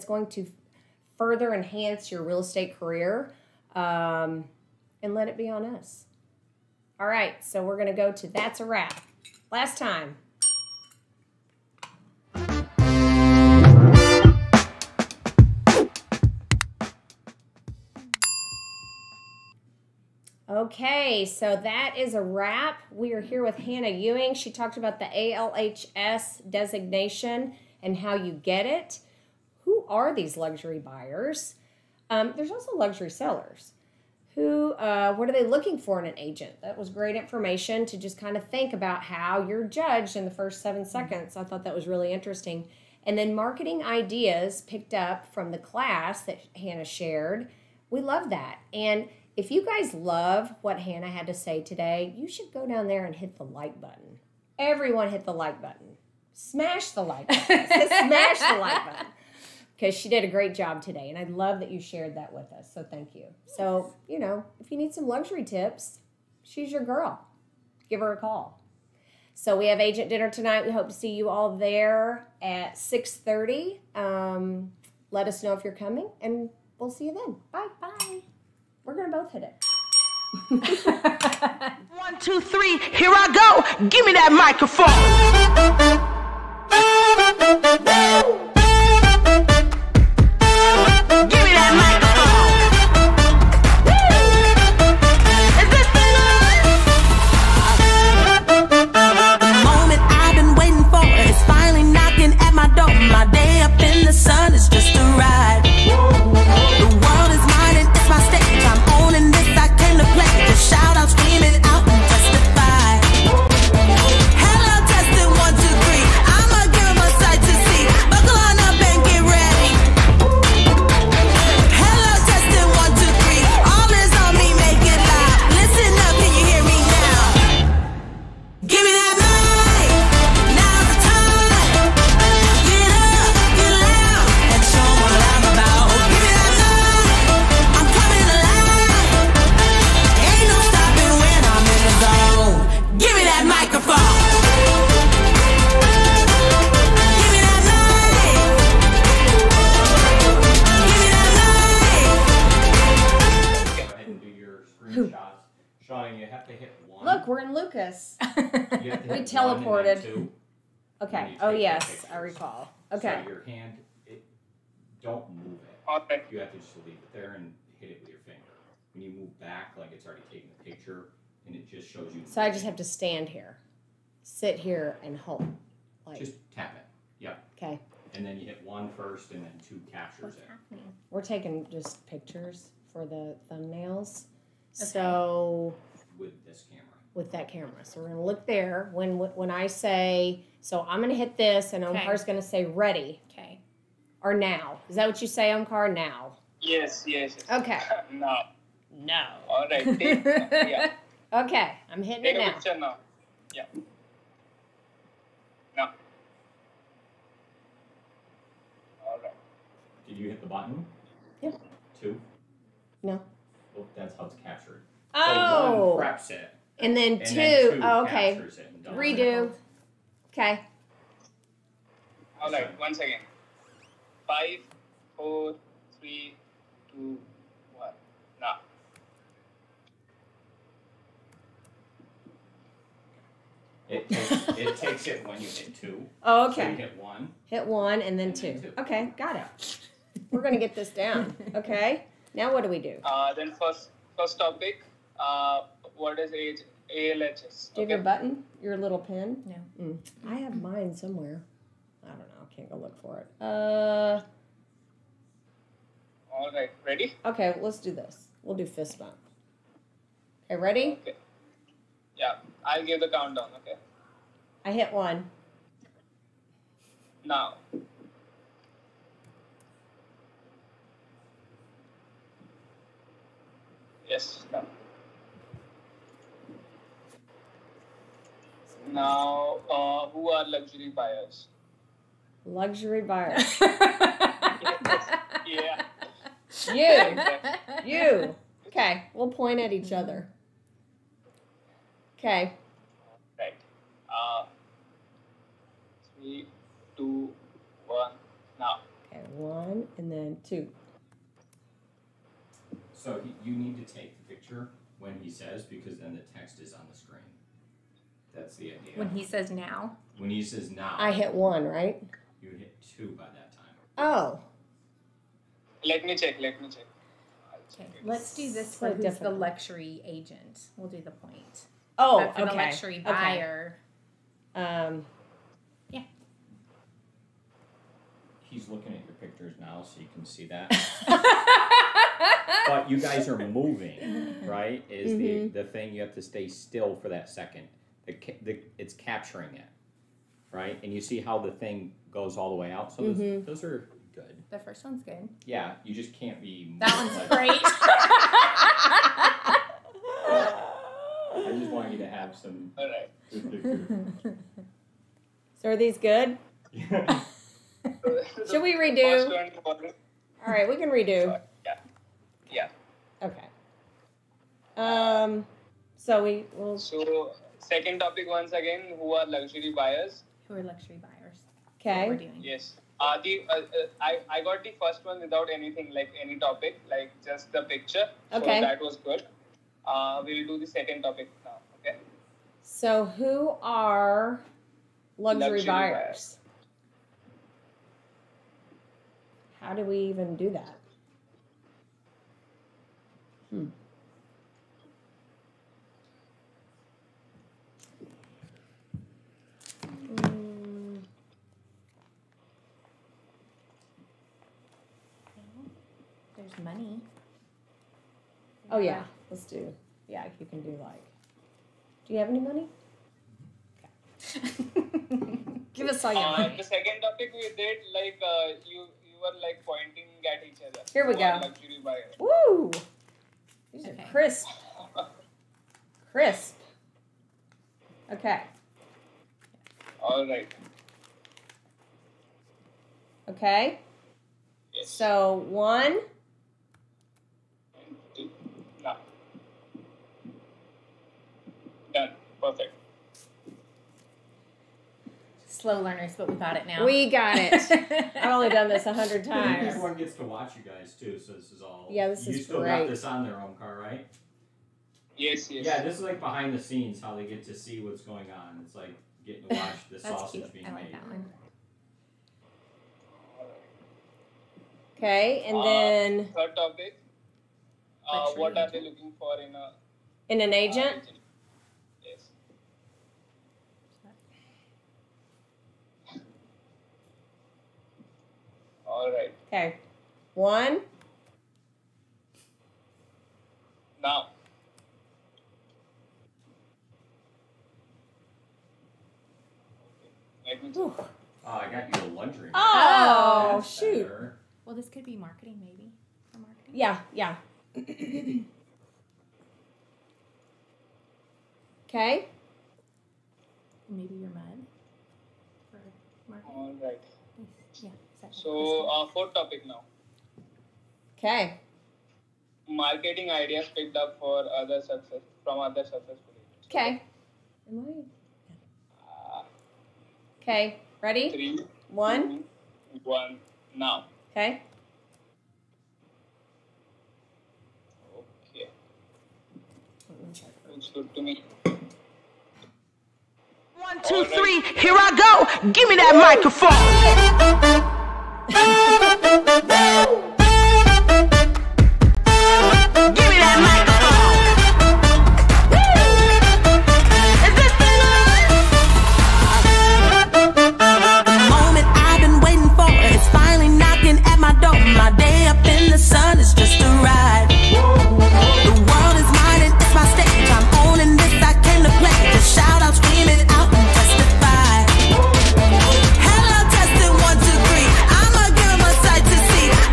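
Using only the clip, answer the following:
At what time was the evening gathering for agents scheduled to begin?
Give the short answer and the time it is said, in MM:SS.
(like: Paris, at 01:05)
6:30, at 01:12.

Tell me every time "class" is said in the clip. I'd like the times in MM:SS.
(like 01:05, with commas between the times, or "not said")
00:45.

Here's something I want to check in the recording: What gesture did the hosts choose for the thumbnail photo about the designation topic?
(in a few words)
Fist bump.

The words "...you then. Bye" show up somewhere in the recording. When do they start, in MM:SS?
01:17.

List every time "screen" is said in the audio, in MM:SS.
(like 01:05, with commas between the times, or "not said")
05:06.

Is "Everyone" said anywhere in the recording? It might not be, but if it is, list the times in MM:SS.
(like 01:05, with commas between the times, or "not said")
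00:54, 07:29.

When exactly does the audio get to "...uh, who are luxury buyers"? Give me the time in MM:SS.
04:39.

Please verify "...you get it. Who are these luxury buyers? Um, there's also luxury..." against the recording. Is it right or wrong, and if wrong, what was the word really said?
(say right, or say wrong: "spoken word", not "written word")
right.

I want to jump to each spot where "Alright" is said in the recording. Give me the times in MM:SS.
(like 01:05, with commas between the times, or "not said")
05:52.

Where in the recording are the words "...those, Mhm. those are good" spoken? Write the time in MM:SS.
05:43.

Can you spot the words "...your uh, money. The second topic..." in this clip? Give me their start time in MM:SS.
06:56.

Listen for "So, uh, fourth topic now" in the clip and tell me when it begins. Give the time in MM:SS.
08:28.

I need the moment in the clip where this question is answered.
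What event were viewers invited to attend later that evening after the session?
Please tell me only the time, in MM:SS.
01:09.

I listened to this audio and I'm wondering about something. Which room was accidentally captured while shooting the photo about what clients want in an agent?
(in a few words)
Laundry room.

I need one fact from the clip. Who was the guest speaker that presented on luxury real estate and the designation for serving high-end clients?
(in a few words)
Hannah Ewing.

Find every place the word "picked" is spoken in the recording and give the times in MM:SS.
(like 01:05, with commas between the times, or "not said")
00:44, 08:33.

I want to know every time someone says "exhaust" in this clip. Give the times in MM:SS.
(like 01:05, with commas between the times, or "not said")
not said.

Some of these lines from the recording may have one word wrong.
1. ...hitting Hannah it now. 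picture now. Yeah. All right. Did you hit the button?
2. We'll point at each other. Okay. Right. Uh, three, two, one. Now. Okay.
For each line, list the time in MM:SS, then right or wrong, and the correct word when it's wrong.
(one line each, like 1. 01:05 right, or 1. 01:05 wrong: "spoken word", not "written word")
1. 03:22 wrong: "Take", not "Hannah"
2. 04:49 right.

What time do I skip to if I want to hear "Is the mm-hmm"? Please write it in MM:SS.
05:34.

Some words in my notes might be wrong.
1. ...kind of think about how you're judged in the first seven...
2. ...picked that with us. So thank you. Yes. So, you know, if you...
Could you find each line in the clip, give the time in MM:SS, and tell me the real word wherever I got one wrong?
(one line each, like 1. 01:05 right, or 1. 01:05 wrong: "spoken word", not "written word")
1. 00:38 right
2. 01:01 wrong: "shared", not "picked".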